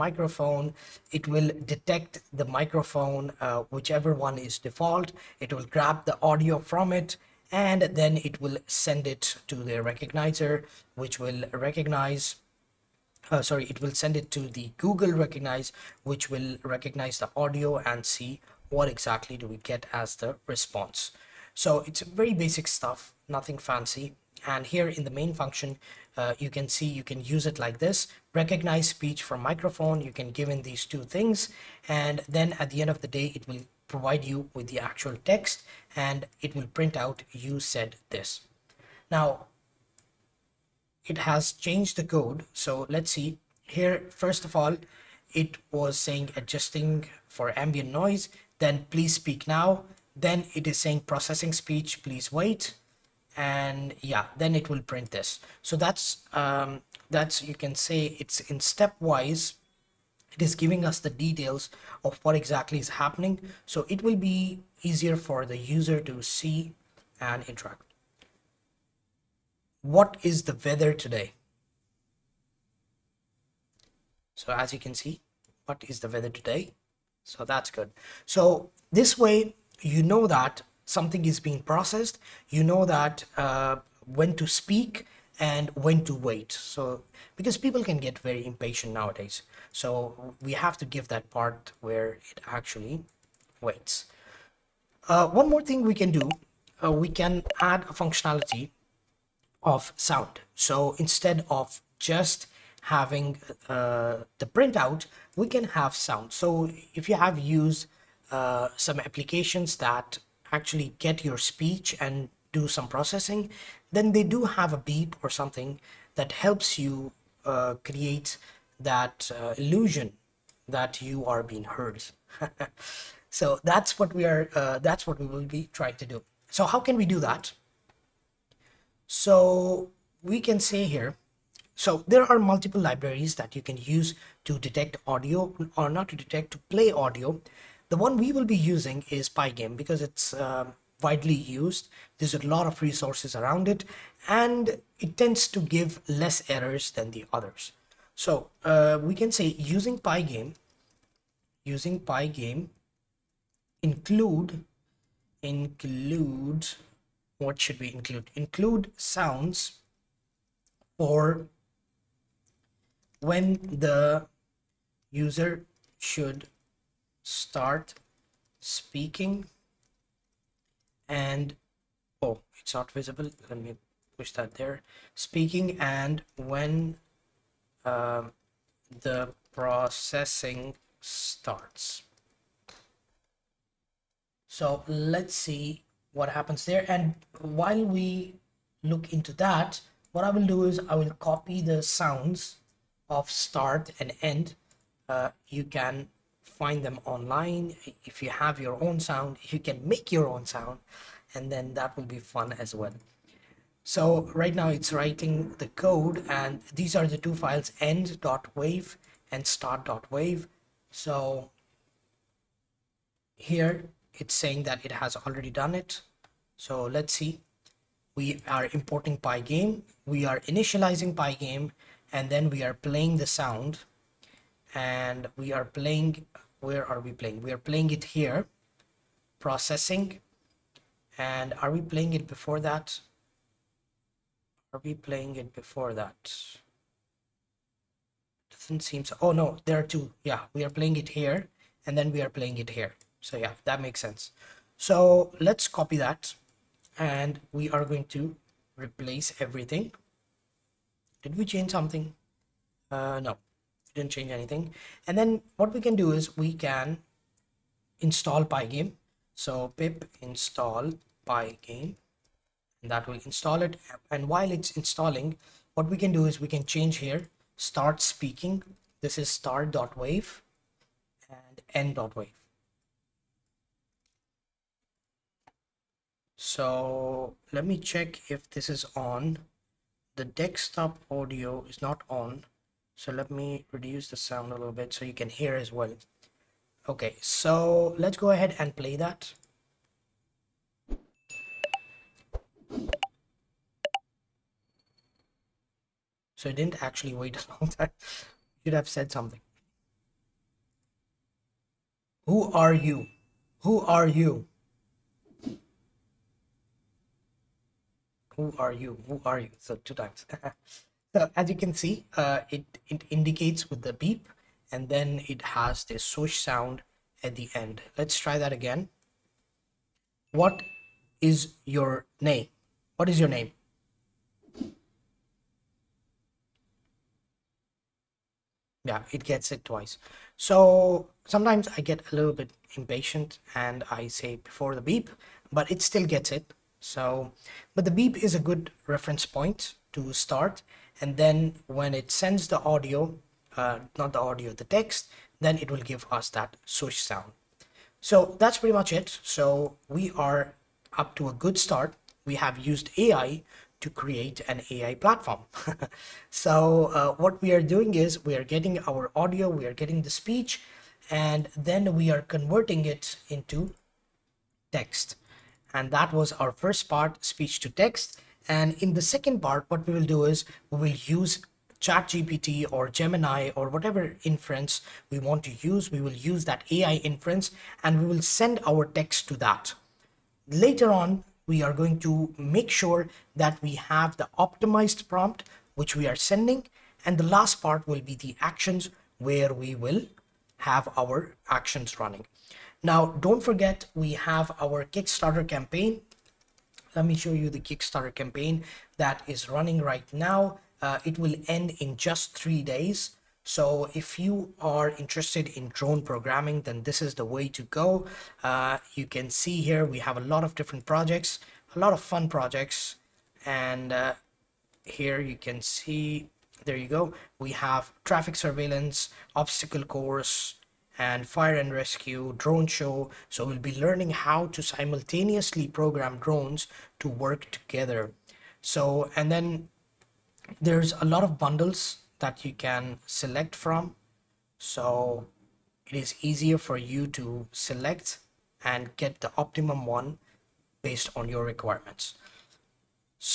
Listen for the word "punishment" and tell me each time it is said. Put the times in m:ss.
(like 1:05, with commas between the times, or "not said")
not said.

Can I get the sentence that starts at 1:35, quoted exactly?
Uh, one more thing we can do, uh, we can add a functionality of sound.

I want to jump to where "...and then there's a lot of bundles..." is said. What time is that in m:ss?
7:09.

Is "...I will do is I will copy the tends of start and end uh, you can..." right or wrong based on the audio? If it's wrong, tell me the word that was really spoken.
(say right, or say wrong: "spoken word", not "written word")
wrong: "sounds", not "tends".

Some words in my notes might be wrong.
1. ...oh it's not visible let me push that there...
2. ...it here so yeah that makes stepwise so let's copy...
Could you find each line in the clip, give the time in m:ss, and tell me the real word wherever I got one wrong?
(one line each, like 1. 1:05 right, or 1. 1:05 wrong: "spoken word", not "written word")
1. 2:52 right
2. 4:02 wrong: "sense", not "stepwise".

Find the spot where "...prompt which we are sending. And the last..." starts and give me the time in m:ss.
6:25.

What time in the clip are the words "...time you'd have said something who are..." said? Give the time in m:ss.
4:57.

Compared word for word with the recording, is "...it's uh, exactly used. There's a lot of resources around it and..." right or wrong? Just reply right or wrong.
wrong.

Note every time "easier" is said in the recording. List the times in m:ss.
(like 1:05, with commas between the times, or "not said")
1:04, 7:16.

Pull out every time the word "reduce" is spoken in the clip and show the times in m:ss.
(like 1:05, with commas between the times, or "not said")
4:43.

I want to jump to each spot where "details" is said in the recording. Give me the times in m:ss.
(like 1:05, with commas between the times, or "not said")
1:01.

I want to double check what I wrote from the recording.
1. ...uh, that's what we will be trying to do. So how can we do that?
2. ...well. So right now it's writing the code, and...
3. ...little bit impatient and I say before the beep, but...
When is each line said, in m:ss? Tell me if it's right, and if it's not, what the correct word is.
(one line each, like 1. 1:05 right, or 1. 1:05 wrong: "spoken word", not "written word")
1. 2:04 right
2. 3:22 right
3. 5:32 right.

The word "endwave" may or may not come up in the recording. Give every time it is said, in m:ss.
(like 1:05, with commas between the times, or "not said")
3:27, 4:31.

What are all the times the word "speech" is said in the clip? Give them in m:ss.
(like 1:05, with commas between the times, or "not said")
0:28, 0:51, 1:51, 6:00, 6:07.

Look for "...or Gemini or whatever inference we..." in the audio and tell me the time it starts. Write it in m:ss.
6:12.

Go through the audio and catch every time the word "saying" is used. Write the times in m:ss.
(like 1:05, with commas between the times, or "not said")
0:45, 0:50, 3:34.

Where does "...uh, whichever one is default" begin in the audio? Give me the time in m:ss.
0:03.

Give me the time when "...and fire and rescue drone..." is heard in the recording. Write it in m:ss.
7:00.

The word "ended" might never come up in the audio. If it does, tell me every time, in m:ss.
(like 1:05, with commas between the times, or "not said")
not said.